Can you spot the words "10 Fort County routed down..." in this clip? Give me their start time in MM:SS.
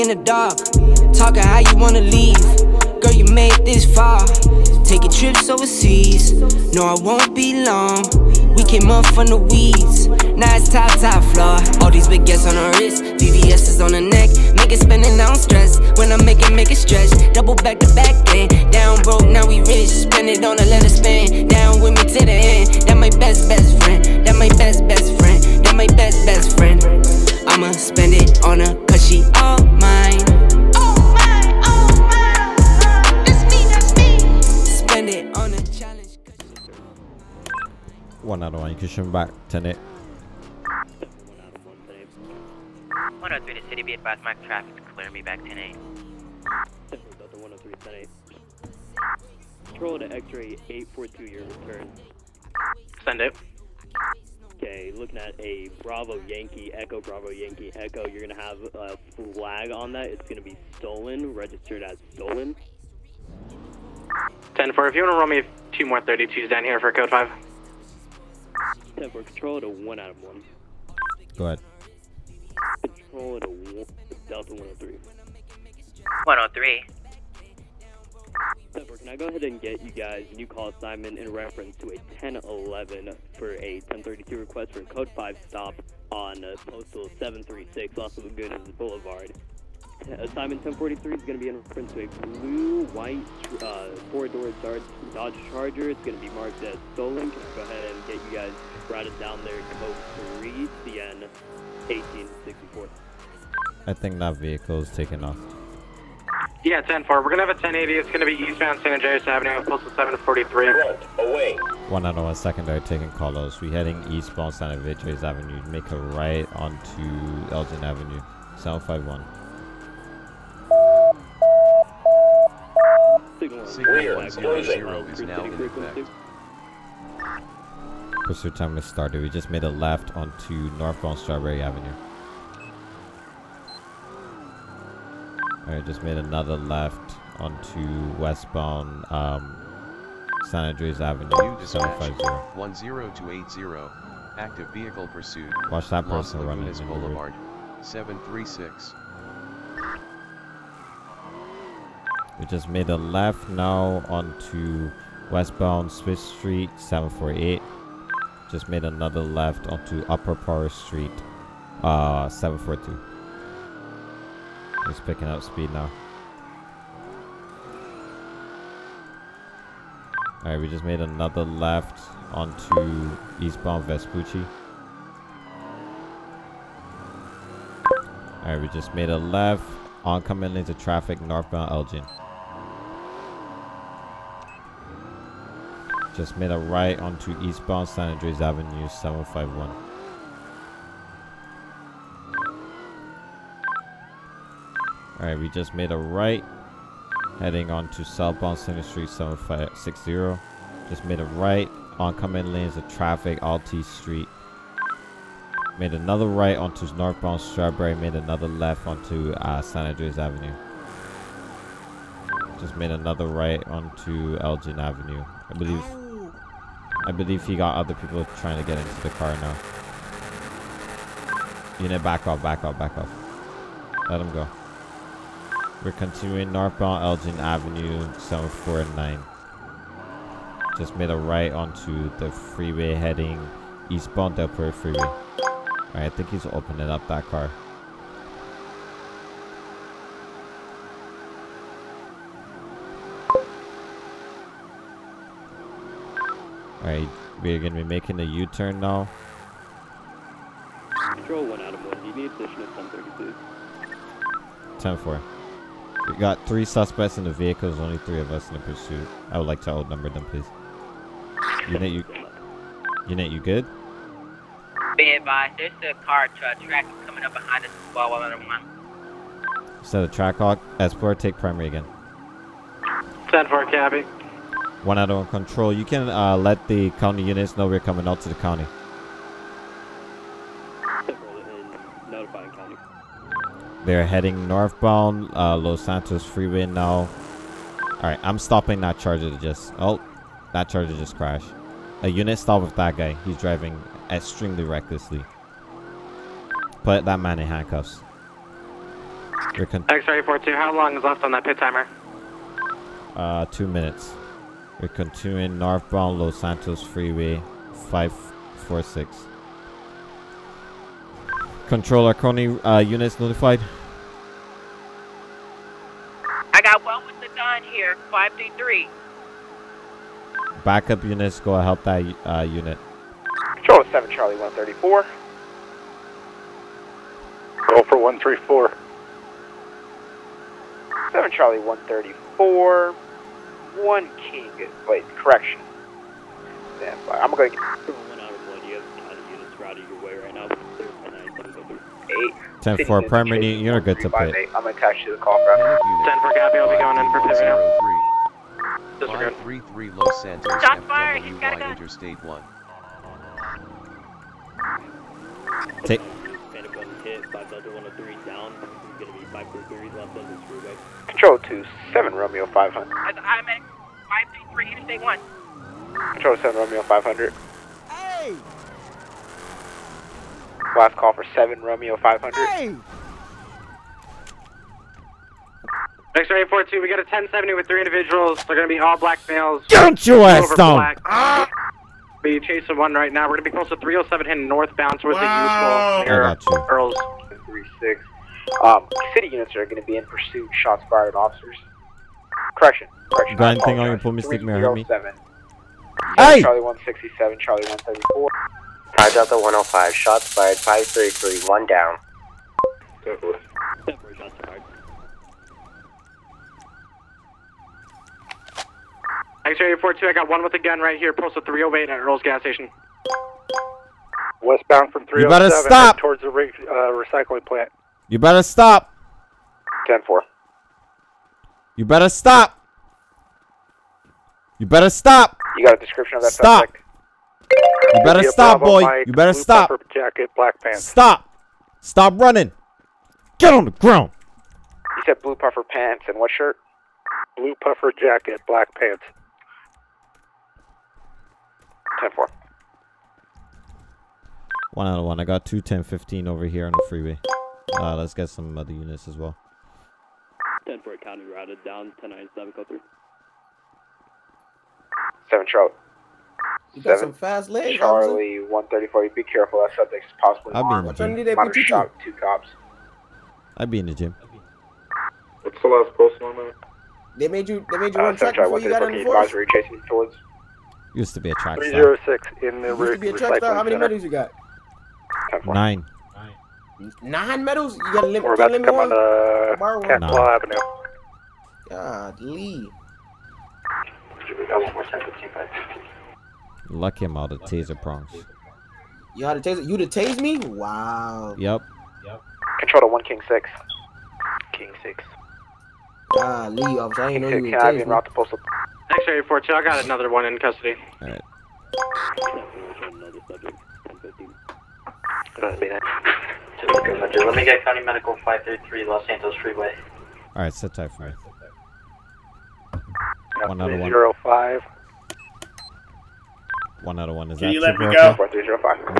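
07:30.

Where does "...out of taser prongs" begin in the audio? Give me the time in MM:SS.
08:07.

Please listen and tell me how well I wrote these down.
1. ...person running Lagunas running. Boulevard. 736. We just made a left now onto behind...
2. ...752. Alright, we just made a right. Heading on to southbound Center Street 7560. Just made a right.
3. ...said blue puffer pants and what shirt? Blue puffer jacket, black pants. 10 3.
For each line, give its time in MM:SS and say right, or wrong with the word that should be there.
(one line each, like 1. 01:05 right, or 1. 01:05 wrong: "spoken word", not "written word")
1. 02:26 wrong: "westbound", not "behind"
2. 03:08 wrong: "751", not "752"
3. 07:15 wrong: "4", not "3".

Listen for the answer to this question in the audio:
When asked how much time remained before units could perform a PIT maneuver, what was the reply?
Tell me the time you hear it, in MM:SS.
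05:03.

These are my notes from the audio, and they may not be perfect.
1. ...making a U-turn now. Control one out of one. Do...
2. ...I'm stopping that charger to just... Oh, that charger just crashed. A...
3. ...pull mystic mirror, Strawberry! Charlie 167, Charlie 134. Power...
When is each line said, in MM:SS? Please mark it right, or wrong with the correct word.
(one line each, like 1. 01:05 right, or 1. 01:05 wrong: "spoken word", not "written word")
1. 04:07 right
2. 04:48 right
3. 06:33 wrong: "Hey", not "Strawberry".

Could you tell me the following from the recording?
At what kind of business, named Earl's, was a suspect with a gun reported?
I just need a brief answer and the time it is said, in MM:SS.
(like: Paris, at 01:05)
gas station, at 06:51.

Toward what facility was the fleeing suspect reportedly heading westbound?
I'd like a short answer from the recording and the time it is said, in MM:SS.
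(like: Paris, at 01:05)
recycling plant, at 06:57.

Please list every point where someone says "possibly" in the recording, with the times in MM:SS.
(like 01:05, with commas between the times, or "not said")
07:40.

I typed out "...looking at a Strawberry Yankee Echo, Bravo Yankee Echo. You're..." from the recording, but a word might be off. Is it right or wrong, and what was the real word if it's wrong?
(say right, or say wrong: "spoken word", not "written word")
wrong: "Bravo", not "Strawberry".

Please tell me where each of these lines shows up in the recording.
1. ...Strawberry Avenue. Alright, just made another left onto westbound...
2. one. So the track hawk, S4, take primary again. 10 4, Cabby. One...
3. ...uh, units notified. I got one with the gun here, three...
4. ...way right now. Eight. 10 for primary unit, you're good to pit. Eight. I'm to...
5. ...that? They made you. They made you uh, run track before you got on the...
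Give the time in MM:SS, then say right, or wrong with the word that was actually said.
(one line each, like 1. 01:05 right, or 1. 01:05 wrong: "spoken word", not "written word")
1. 02:11 right
2. 04:28 right
3. 05:12 wrong: "five", not "three"
4. 05:40 right
5. 07:46 right.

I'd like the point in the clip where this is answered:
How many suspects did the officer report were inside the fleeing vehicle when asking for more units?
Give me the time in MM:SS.
04:16.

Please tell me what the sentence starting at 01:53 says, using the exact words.
We're heading eastbound San Andreas Avenue.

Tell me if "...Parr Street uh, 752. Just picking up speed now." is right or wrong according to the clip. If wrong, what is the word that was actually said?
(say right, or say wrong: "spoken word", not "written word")
wrong: "742", not "752".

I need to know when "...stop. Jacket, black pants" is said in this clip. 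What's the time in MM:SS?
07:09.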